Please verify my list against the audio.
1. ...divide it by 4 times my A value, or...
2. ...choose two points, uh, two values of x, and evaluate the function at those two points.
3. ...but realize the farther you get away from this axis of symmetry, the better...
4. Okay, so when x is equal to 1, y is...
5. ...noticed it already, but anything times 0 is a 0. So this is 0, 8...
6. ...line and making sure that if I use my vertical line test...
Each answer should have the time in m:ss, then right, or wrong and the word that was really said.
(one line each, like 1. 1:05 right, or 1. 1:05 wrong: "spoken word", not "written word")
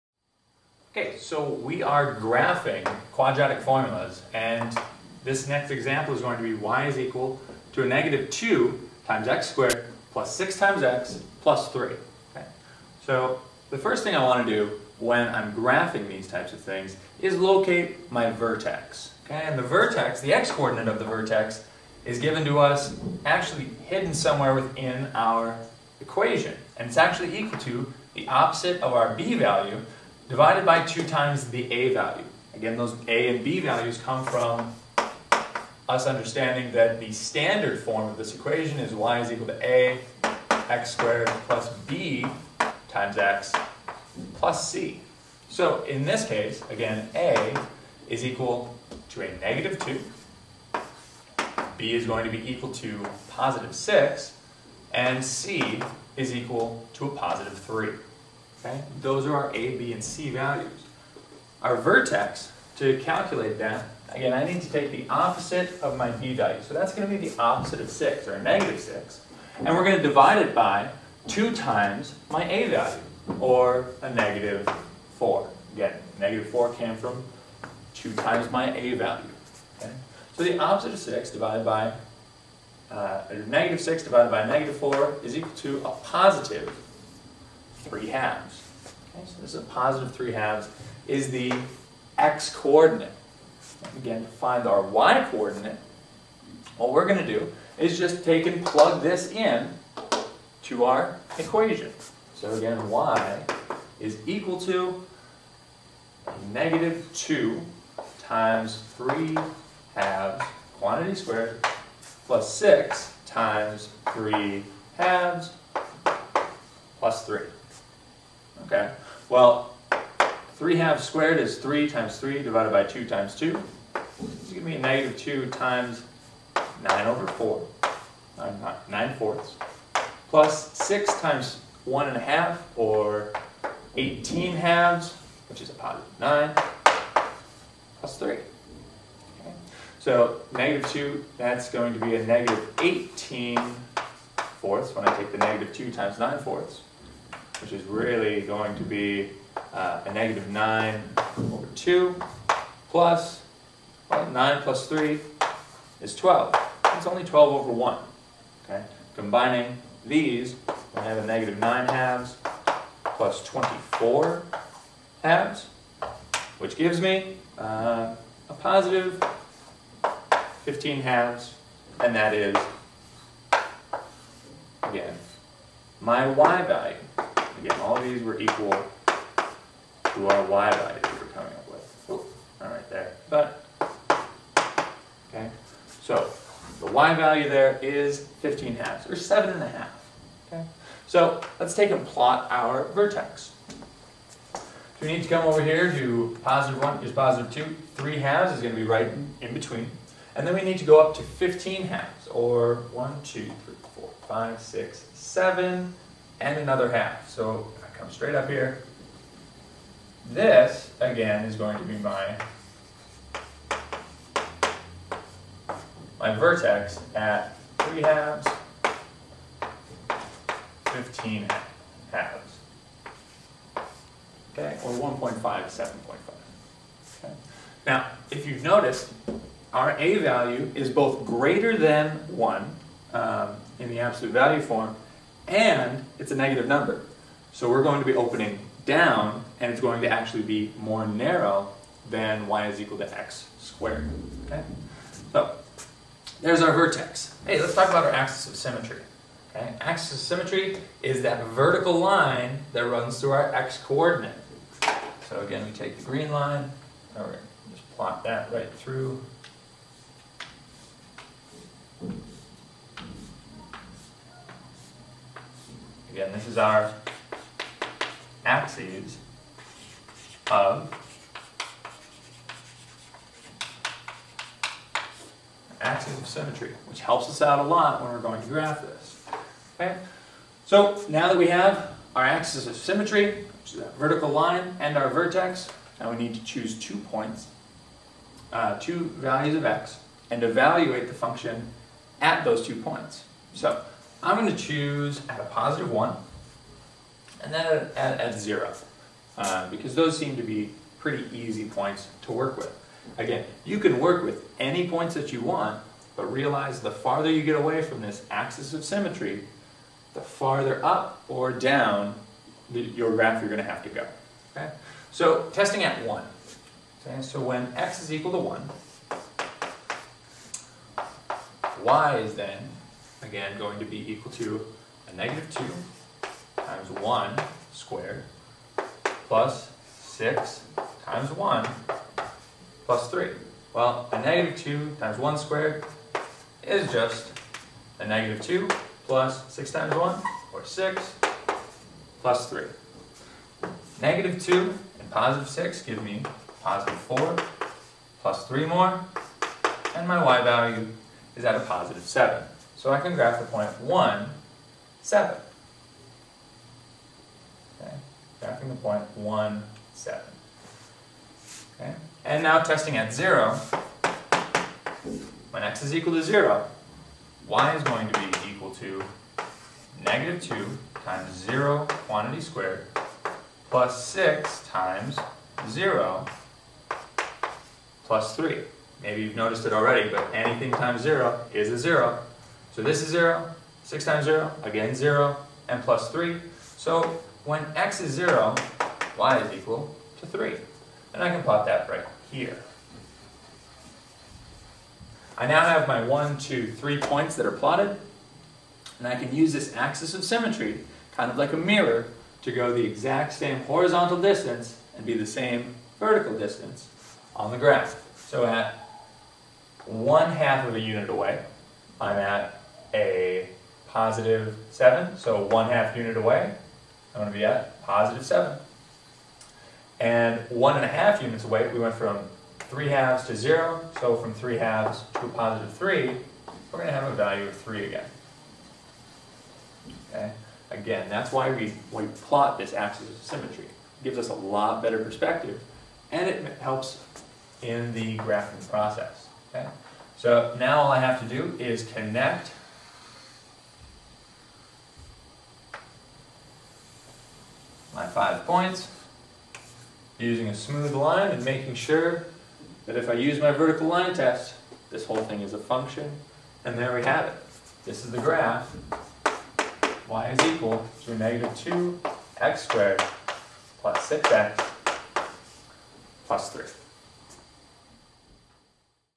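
1. 1:10 wrong: "2", not "4"
2. 4:46 right
3. 5:06 wrong: "farther", not "better"
4. 5:17 right
5. 6:19 wrong: "6", not "8"
6. 7:30 right.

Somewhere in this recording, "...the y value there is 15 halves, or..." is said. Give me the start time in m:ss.
3:06.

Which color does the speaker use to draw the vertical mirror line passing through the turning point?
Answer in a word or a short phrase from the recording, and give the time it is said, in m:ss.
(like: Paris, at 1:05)
Green, at 4:15.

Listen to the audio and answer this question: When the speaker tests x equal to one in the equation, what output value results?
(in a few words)
7.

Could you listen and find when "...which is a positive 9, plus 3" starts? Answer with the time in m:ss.
2:15.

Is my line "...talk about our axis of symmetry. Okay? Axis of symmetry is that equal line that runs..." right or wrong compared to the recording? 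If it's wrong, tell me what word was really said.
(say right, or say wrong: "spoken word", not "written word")
wrong: "vertical", not "equal".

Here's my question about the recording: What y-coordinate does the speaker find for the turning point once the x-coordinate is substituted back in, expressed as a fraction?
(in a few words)
15/2.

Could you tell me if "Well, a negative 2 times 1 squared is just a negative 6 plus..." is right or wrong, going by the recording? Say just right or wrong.
wrong.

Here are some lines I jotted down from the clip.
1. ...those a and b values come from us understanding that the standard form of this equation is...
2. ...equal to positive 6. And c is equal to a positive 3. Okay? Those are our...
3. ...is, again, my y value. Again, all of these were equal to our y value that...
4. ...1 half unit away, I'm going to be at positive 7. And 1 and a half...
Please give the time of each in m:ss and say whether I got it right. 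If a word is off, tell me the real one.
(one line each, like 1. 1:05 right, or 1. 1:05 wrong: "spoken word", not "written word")
1. 0:32 right
2. 0:52 right
3. 2:52 right
4. 6:55 right.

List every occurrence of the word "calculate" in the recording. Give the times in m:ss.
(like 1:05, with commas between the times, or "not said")
1:03.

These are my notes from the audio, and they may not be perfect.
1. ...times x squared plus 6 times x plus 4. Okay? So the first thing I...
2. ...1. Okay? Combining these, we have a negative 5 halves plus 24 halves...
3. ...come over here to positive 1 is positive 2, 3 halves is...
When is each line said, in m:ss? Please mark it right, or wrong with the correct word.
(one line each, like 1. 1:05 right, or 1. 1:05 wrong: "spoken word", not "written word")
1. 0:09 wrong: "3", not "4"
2. 2:37 wrong: "9", not "5"
3. 3:15 right.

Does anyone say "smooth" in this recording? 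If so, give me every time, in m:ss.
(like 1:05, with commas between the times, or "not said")
7:30.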